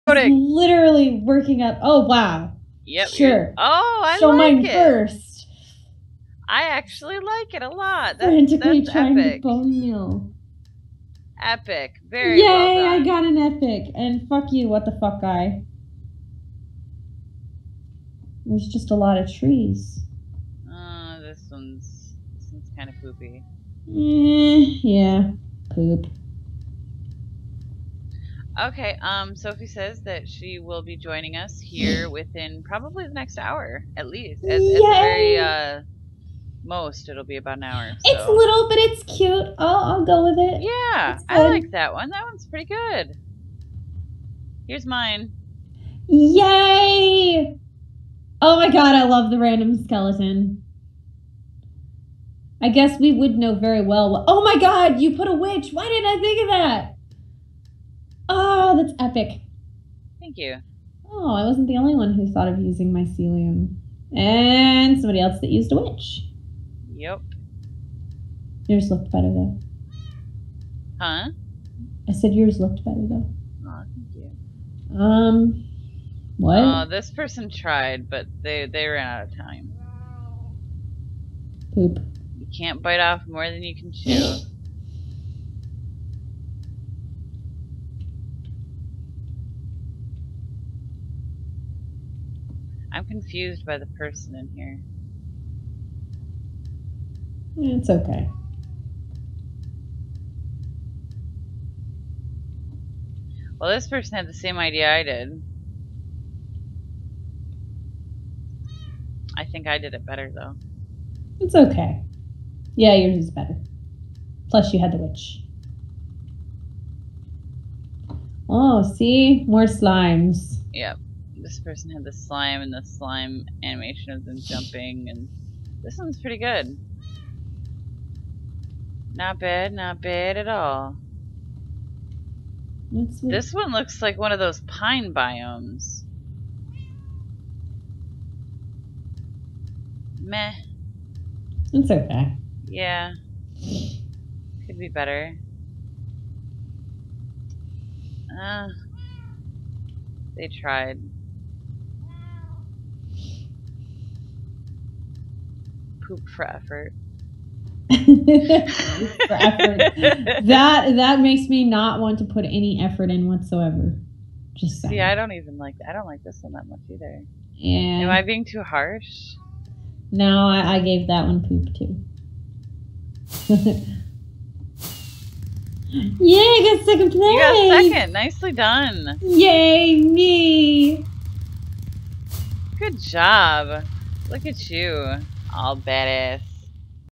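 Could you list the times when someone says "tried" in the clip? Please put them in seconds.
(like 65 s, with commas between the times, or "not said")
77 s, 150 s.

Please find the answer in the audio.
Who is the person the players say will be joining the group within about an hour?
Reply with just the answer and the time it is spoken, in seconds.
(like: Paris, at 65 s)
Sophie, at 29 s.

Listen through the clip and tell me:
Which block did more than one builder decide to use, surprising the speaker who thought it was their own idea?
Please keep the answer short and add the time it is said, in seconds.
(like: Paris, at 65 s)
Mycelium, at 62 s.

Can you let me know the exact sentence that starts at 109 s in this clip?
I think I did it better, though.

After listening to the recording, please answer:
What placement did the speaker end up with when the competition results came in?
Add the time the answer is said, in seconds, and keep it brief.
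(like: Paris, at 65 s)
Second place, at 176 s.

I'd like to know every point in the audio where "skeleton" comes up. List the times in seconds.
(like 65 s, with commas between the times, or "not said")
49 s.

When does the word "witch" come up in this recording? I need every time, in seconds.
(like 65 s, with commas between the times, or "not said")
55 s, 65 s, 114 s.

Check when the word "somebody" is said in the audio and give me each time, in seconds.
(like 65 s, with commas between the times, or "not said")
64 s.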